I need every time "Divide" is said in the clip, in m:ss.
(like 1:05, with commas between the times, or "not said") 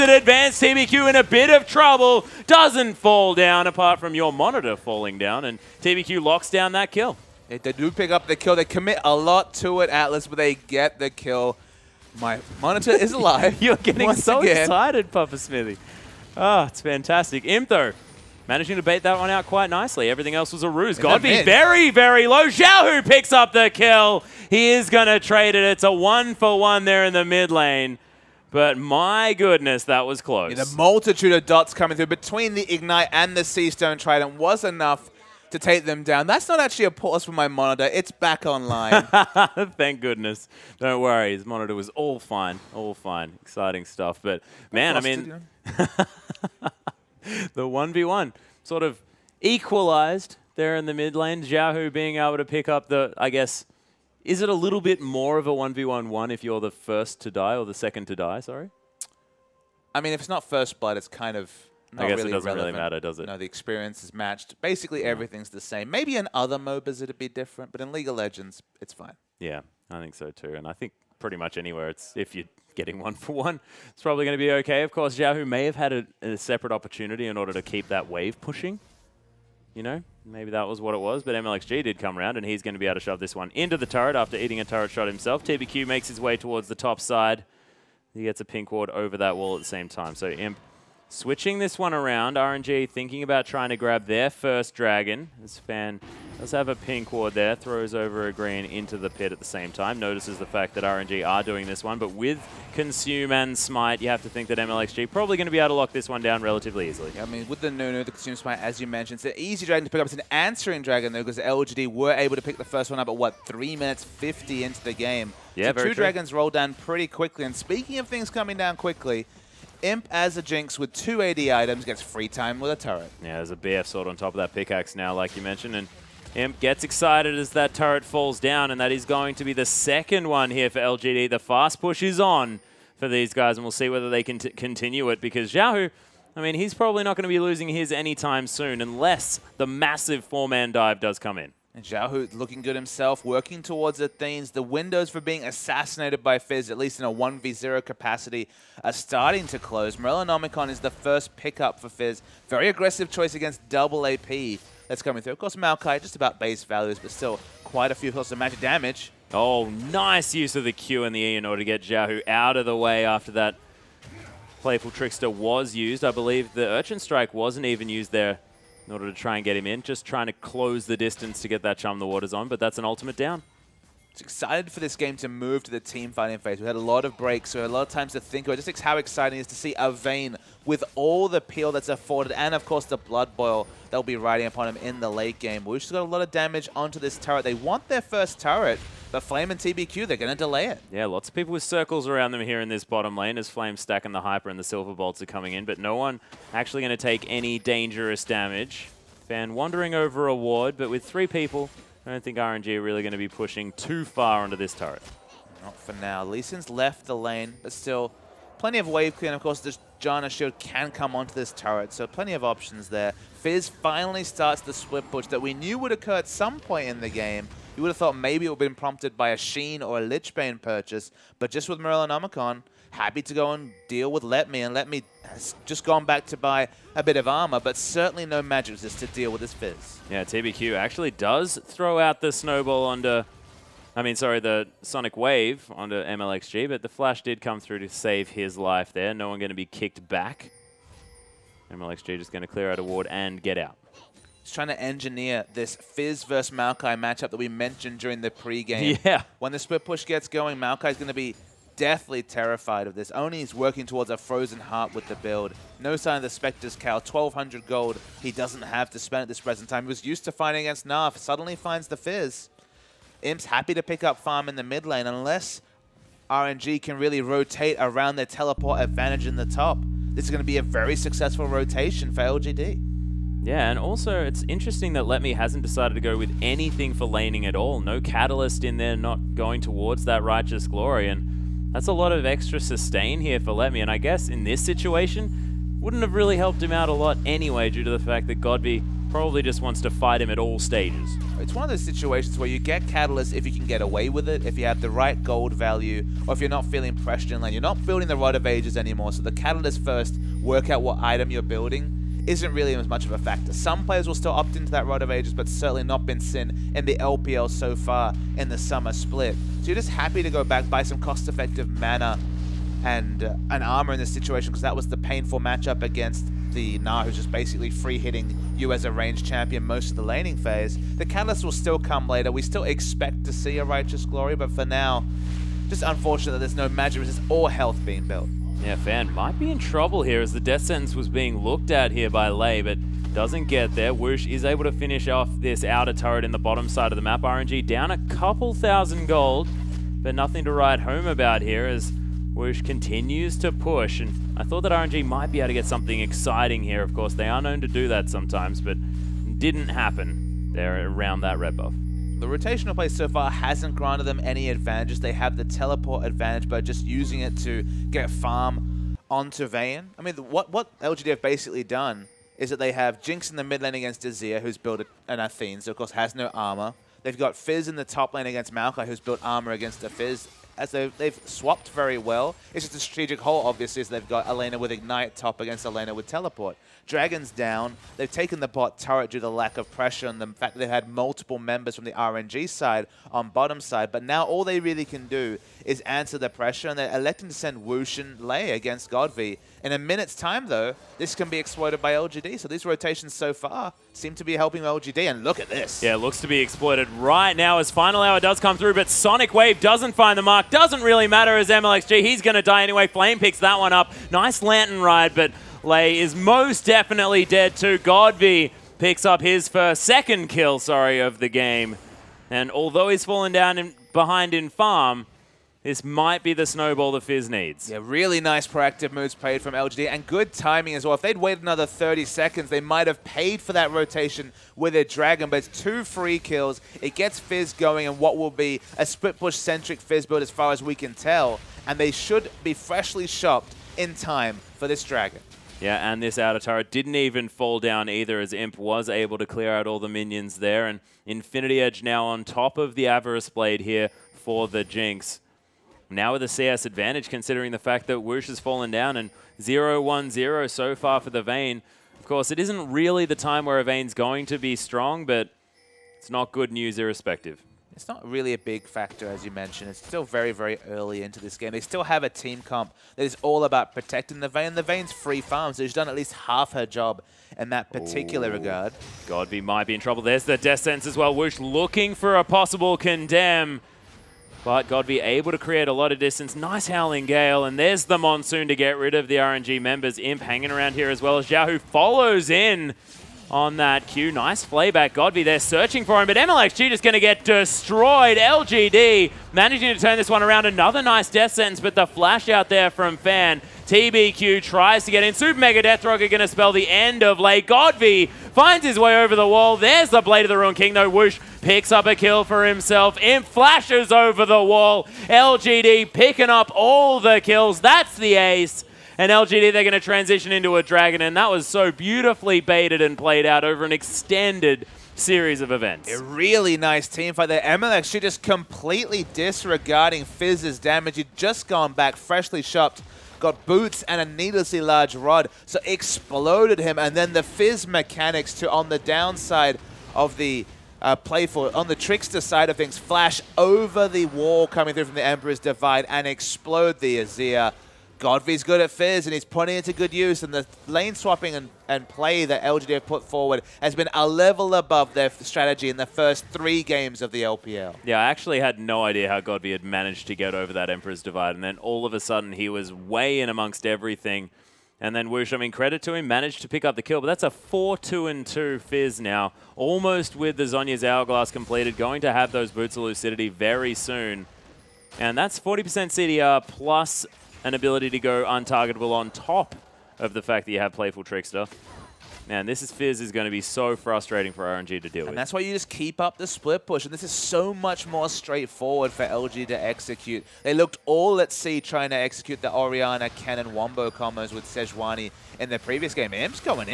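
8:55, 9:11.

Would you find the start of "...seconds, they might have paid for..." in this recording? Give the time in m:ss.
7:02.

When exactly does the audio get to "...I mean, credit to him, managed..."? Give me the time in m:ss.
9:15.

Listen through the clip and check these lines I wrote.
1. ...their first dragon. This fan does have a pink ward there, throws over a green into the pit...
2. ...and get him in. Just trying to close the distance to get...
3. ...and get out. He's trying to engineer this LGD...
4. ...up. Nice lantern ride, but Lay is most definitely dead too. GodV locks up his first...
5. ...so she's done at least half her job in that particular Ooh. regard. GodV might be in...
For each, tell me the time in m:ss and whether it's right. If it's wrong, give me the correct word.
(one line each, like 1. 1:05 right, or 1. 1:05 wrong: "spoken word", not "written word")
1. 1:34 right
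2. 2:49 right
3. 4:03 wrong: "Fizz", not "LGD"
4. 6:43 wrong: "picks", not "locks"
5. 7:45 right.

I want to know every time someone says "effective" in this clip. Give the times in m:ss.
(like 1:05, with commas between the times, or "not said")
5:10.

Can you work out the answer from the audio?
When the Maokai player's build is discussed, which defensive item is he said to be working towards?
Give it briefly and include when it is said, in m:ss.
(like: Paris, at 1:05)
Frozen Heart, at 4:14.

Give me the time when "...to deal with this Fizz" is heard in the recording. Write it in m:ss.
3:48.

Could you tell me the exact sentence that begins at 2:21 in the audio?
And Zhao looking good himself, working towards Athenes.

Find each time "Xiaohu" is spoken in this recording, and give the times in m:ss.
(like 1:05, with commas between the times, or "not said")
0:22, 1:15, 2:15, 8:01.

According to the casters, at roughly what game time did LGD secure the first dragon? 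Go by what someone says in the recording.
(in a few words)
3 minutes 50.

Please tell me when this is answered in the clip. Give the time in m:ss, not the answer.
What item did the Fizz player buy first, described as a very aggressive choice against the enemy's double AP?
2:29.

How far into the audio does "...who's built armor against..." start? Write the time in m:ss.
6:08.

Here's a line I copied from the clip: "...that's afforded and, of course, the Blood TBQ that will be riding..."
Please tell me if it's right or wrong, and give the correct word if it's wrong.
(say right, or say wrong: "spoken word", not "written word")
wrong: "Boil", not "TBQ".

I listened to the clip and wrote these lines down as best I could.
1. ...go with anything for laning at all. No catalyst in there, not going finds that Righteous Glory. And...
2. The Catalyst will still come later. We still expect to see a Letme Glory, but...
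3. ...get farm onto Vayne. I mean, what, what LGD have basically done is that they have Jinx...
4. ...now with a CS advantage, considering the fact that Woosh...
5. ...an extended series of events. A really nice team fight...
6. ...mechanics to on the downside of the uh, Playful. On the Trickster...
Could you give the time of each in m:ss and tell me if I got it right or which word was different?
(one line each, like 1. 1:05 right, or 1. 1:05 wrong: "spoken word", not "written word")
1. 4:35 wrong: "towards", not "finds"
2. 5:20 wrong: "Righteous", not "Letme"
3. 5:57 right
4. 7:25 right
5. 8:33 right
6. 8:47 right.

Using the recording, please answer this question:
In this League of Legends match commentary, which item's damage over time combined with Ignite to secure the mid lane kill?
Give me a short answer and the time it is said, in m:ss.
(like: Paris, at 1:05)
Sea Stone Trident, at 0:33.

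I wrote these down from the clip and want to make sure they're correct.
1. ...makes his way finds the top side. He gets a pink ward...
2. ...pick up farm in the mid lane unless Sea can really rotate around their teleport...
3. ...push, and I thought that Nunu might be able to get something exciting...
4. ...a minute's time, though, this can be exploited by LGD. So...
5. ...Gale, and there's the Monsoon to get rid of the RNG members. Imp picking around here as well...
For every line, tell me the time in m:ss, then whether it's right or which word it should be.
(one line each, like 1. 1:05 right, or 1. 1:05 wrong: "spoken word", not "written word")
1. 1:25 wrong: "towards", not "finds"
2. 4:23 wrong: "RNG", not "Sea"
3. 5:43 wrong: "RNG", not "Nunu"
4. 6:29 right
5. 7:57 wrong: "hanging", not "picking".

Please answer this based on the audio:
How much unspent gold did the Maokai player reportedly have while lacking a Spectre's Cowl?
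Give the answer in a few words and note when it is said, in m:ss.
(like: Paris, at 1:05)
1,200, at 4:16.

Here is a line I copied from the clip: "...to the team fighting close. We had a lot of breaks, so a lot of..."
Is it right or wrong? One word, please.
wrong.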